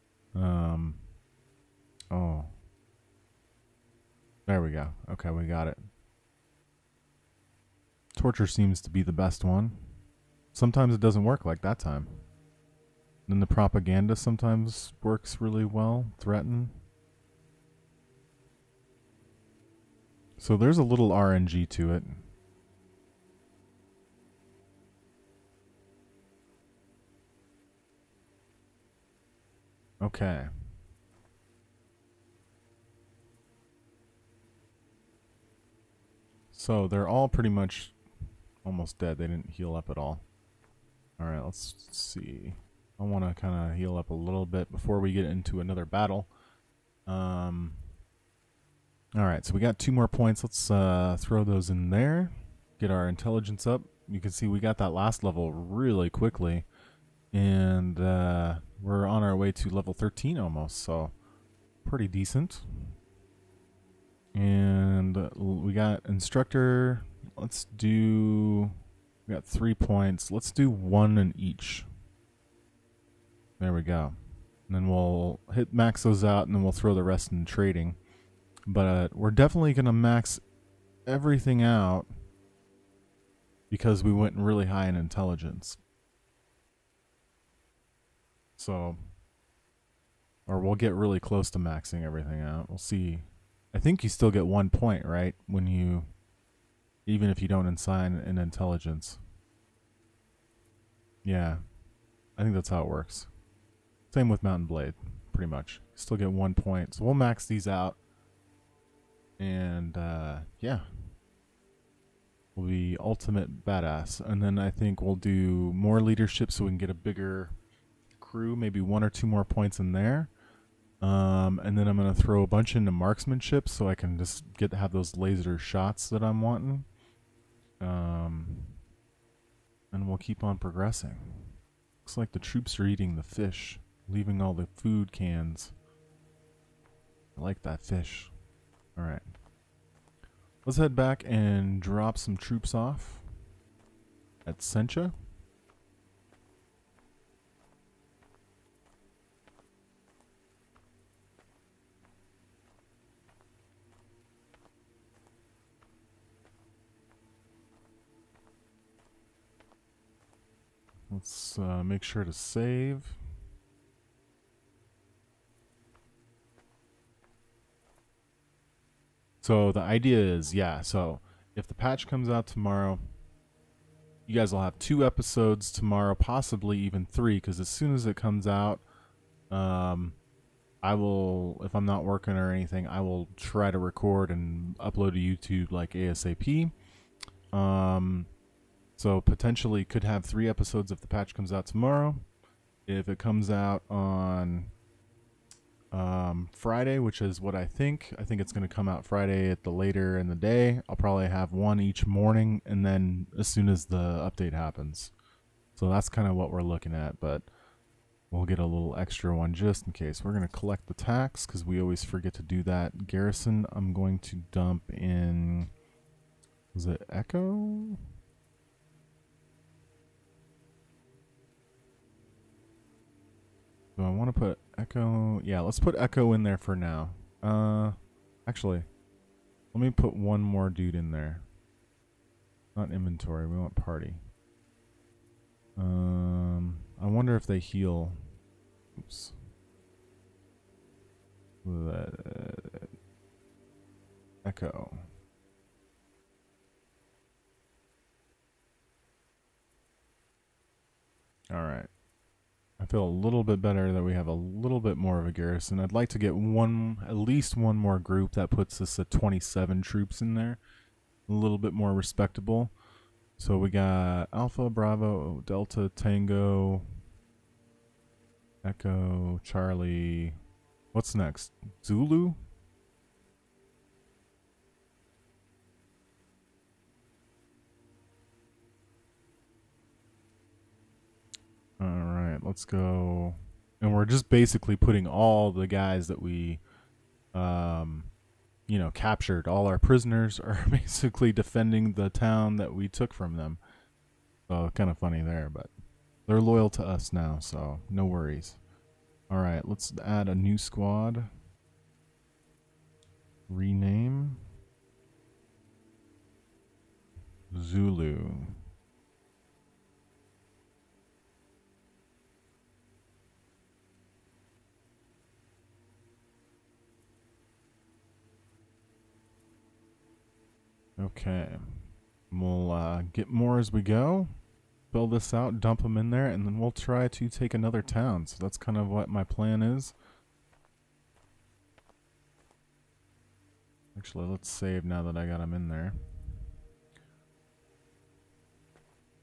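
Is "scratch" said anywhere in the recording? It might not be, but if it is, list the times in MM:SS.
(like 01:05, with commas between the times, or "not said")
not said.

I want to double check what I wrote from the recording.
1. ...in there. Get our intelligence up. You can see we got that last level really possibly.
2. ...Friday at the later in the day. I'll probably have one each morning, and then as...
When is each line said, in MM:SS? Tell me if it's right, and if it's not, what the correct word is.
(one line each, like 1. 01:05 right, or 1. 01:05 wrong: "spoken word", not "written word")
1. 00:51 wrong: "quickly", not "possibly"
2. 03:19 right.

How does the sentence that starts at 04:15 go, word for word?
I'd like to get one, at least one more group that puts us at 27 troops in there.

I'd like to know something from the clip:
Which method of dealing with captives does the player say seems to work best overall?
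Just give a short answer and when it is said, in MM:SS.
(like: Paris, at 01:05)
Torture, at 00:08.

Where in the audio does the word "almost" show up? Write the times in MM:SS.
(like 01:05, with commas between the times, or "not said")
00:38, 01:00.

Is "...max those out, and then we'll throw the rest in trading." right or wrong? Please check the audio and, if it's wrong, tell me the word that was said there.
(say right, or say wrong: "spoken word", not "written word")
right.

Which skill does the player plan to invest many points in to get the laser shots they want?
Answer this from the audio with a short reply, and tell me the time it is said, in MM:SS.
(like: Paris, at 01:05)
Marksmanship, at 02:02.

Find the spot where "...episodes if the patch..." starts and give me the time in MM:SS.
03:10.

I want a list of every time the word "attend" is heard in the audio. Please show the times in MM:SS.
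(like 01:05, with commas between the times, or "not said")
not said.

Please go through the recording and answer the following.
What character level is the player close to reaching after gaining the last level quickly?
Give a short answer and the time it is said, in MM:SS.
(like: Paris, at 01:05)
13, at 00:59.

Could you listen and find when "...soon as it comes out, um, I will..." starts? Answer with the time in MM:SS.
02:57.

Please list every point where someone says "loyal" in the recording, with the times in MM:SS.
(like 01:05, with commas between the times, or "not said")
04:56.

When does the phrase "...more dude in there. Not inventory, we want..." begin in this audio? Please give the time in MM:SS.
03:50.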